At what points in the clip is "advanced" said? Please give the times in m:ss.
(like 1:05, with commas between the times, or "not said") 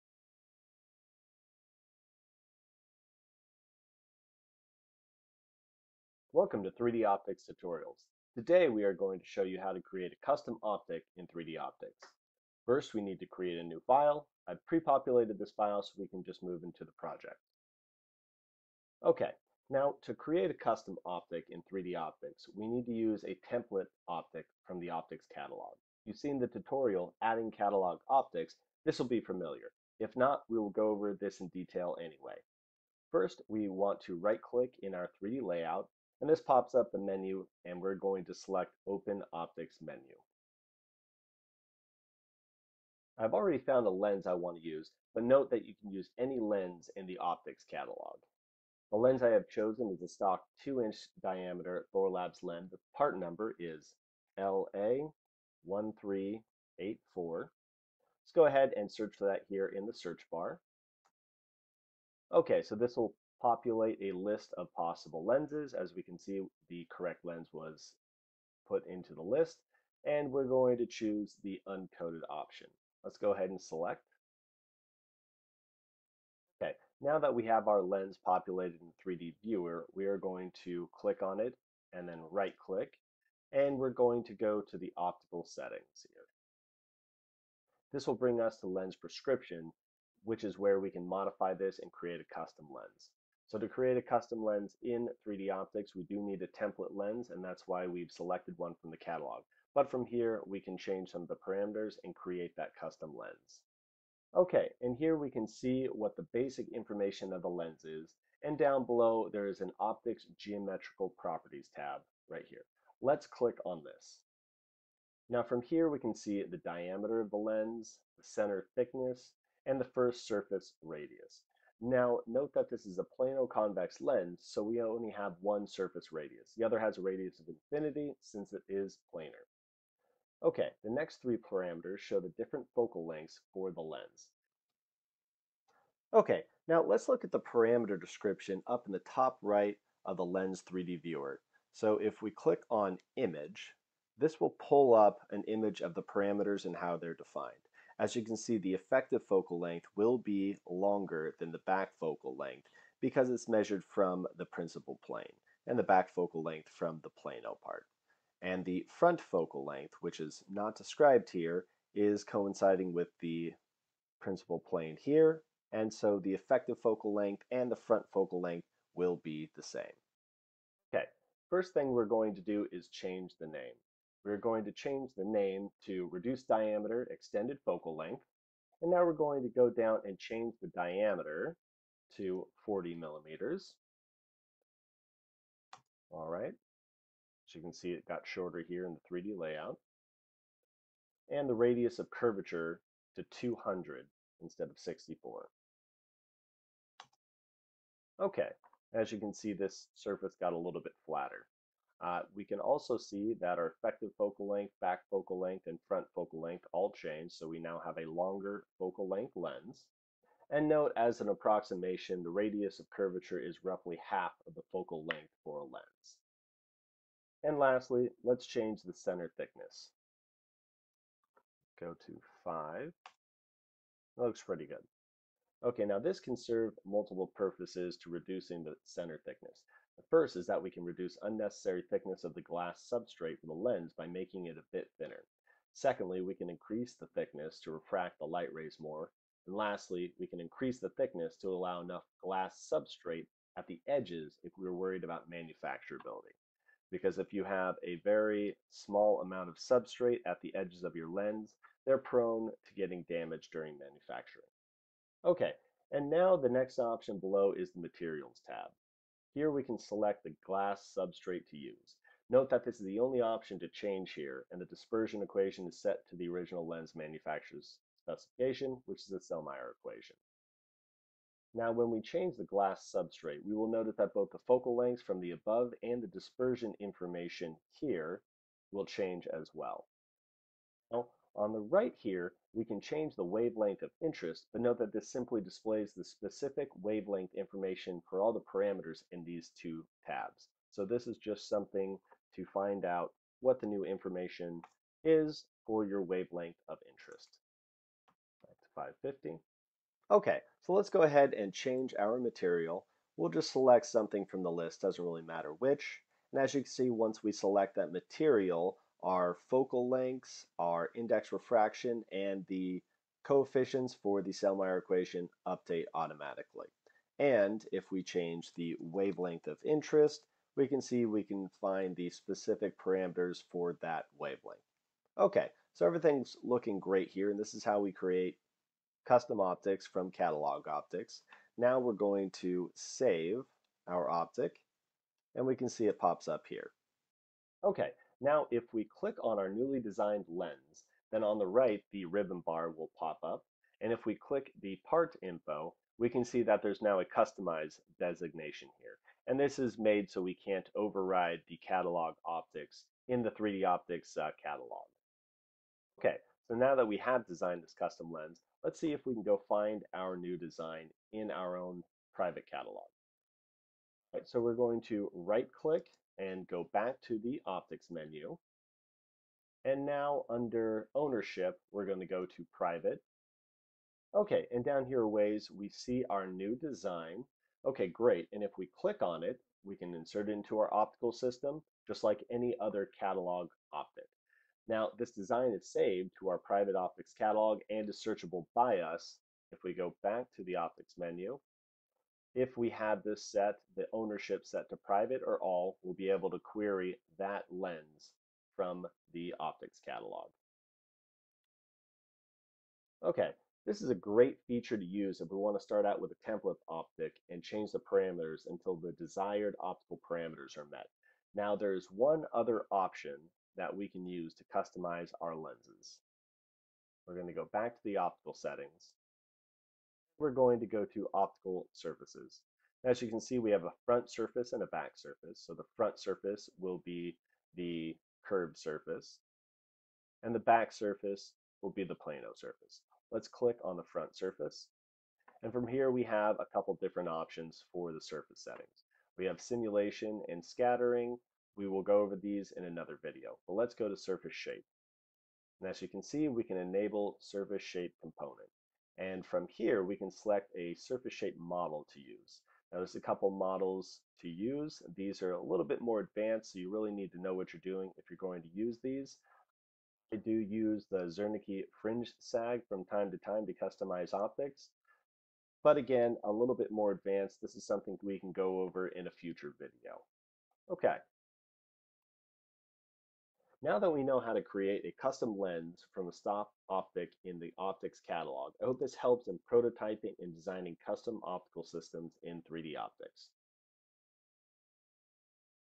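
7:36, 7:46.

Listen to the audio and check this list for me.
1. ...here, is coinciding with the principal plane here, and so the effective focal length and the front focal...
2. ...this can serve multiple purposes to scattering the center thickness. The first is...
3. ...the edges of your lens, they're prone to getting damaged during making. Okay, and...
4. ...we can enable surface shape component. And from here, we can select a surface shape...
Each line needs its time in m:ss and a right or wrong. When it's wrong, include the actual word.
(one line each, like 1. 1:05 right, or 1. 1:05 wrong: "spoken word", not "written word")
1. 2:41 right
2. 3:45 wrong: "reducing", not "scattering"
3. 4:10 wrong: "manufacturing", not "making"
4. 7:26 right.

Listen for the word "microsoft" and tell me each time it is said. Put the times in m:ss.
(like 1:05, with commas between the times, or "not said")
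not said.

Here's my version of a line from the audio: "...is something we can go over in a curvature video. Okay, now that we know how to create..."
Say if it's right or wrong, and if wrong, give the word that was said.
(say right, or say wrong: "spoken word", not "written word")
wrong: "future", not "curvature".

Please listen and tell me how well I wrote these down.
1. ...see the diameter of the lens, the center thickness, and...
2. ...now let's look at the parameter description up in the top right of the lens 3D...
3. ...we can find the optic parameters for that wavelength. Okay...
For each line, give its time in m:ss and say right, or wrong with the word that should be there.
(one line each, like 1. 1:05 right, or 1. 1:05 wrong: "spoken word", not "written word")
1. 1:56 right
2. 2:16 right
3. 5:21 wrong: "specific", not "optic".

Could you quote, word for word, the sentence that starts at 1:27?
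This will bring us to lens prescription, which is where we can modify this and create a custom lens.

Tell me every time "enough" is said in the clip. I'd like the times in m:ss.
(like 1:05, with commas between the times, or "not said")
4:01.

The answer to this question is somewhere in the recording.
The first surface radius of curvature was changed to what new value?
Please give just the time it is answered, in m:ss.
3:13.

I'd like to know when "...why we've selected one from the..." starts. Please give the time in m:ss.
1:37.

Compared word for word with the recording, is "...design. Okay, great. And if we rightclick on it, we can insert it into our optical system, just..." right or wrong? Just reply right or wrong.
wrong.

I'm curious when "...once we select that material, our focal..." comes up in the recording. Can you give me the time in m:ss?
5:06.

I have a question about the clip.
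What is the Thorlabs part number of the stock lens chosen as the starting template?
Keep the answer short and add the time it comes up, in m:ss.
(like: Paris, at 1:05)
LA1384, at 0:54.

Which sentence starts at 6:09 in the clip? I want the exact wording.
And now under ownership, we're going to go to private.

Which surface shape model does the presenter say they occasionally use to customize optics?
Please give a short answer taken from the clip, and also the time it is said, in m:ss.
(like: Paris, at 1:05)
Zernike fringe sag, at 7:41.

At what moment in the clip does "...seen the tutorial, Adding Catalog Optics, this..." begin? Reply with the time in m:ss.
0:26.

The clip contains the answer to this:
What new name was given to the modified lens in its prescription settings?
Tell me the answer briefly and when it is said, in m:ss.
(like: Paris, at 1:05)
reduced diameter extended focal length, at 2:56.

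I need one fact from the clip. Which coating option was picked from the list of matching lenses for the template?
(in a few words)
uncoated.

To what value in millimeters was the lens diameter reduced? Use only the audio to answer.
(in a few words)
40.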